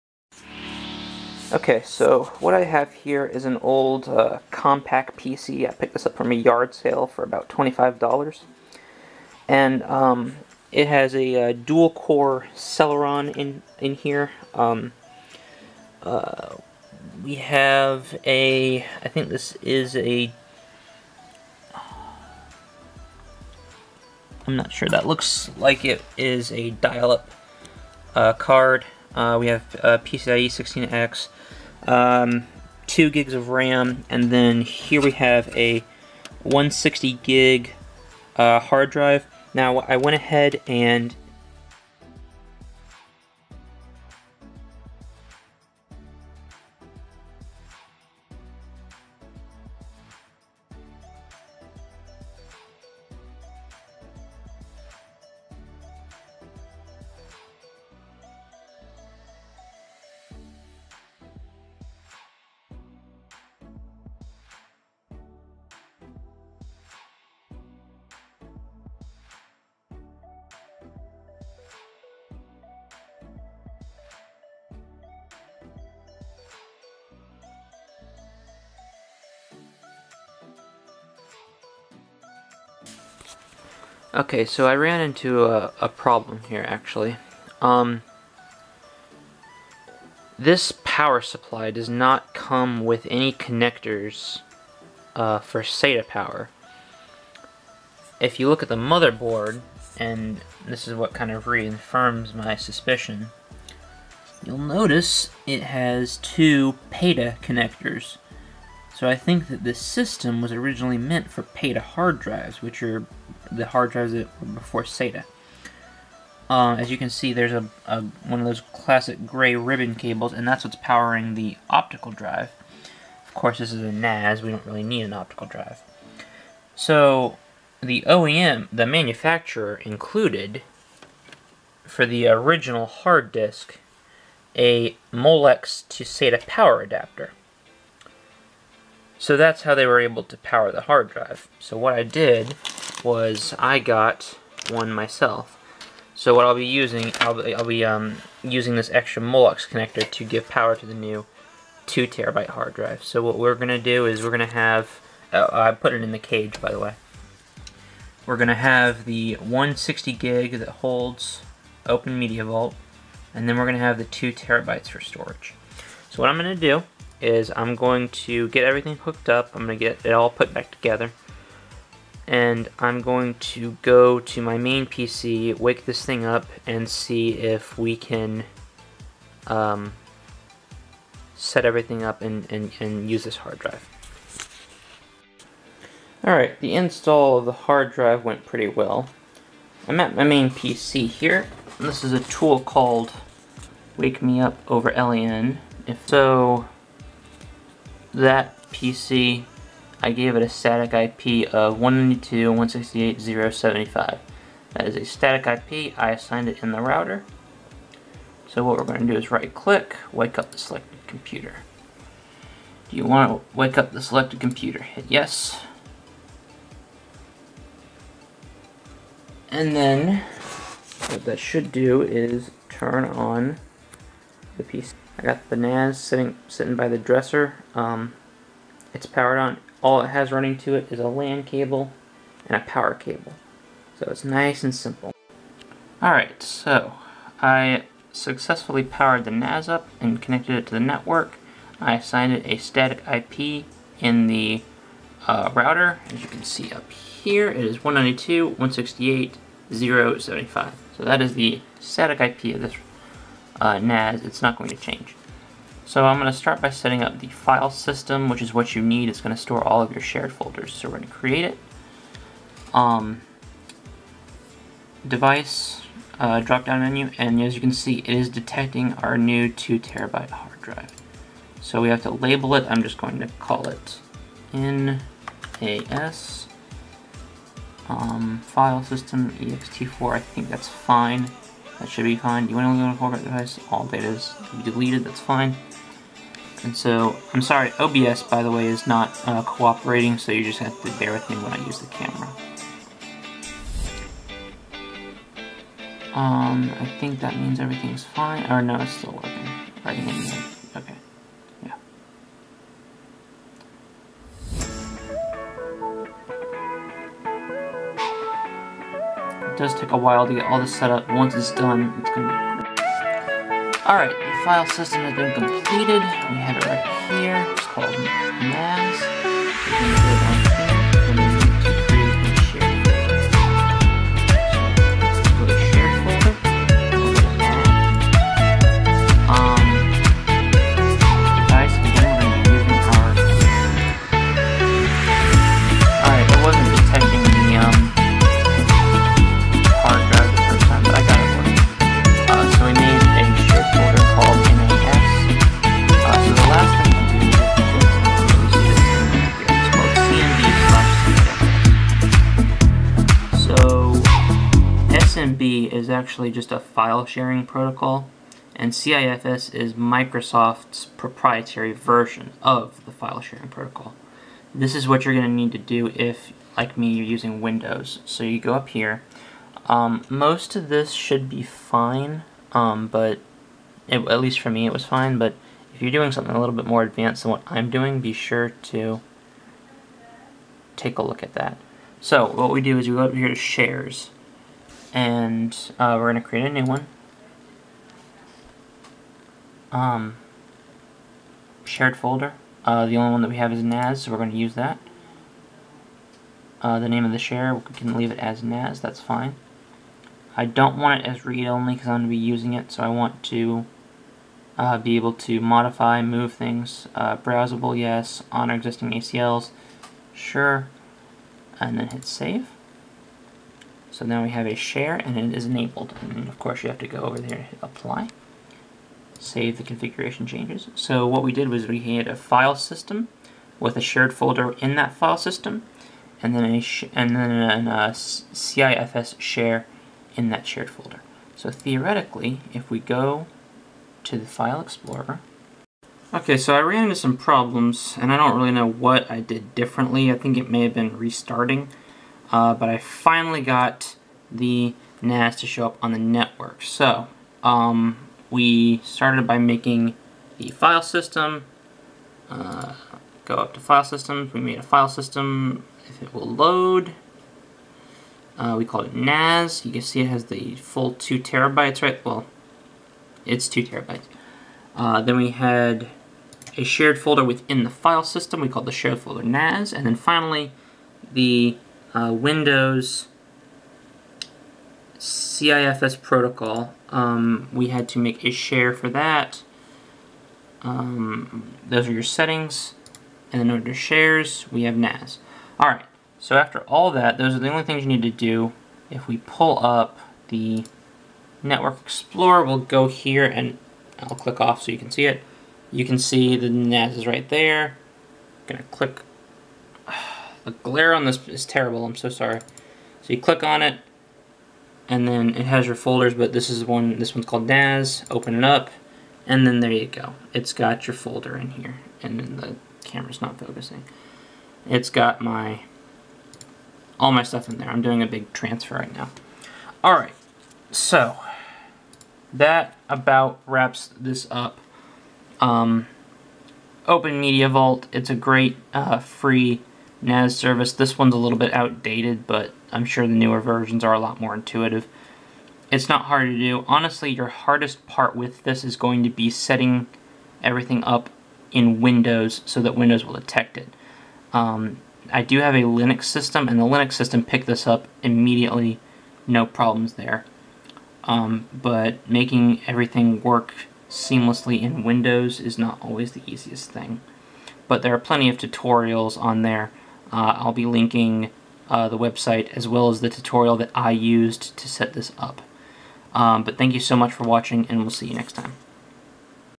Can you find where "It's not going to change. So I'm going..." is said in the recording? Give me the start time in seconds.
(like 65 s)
254 s.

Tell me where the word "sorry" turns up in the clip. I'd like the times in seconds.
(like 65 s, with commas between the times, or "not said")
287 s, 502 s.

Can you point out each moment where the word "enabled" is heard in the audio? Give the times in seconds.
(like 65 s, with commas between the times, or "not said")
415 s.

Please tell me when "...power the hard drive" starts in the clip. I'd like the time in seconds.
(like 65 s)
140 s.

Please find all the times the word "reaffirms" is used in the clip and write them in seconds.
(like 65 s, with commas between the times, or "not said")
101 s.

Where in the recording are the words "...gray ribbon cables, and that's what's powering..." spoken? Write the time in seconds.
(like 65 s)
119 s.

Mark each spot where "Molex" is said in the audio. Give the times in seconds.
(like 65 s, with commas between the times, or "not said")
135 s, 149 s.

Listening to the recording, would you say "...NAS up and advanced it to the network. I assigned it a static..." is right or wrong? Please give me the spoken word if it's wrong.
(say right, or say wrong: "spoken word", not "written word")
wrong: "connected", not "advanced".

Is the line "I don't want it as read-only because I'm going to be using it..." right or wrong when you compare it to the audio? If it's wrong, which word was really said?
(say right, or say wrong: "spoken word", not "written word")
right.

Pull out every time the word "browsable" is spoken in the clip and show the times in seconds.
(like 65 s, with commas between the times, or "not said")
407 s.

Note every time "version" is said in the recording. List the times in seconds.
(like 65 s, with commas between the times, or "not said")
361 s, 533 s.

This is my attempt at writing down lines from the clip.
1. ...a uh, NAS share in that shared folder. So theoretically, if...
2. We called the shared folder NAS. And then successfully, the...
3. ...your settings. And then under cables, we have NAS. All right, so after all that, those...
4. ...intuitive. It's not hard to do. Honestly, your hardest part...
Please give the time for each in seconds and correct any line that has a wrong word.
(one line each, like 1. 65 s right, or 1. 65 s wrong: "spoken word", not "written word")
1. 427 s wrong: "CIFS", not "NAS"
2. 468 s wrong: "finally", not "successfully"
3. 481 s wrong: "shares", not "cables"
4. 534 s right.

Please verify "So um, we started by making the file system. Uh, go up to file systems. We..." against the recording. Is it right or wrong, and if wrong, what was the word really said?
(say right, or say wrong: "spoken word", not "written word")
right.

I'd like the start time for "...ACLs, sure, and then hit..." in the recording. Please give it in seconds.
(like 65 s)
408 s.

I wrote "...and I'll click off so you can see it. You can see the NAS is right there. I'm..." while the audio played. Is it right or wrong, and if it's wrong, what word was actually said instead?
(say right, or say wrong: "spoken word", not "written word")
right.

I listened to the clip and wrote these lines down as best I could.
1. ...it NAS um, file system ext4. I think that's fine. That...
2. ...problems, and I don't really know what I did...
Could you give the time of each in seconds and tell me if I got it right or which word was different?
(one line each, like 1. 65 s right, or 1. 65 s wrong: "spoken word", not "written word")
1. 273 s right
2. 437 s right.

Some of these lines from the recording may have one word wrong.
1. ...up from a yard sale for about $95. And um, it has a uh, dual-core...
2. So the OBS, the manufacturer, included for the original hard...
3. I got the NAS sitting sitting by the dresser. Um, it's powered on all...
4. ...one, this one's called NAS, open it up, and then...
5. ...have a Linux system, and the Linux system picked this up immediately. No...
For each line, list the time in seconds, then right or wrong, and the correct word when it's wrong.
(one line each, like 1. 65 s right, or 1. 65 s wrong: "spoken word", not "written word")
1. 6 s wrong: "25", not "95"
2. 126 s wrong: "OEM", not "OBS"
3. 225 s right
4. 506 s right
5. 545 s right.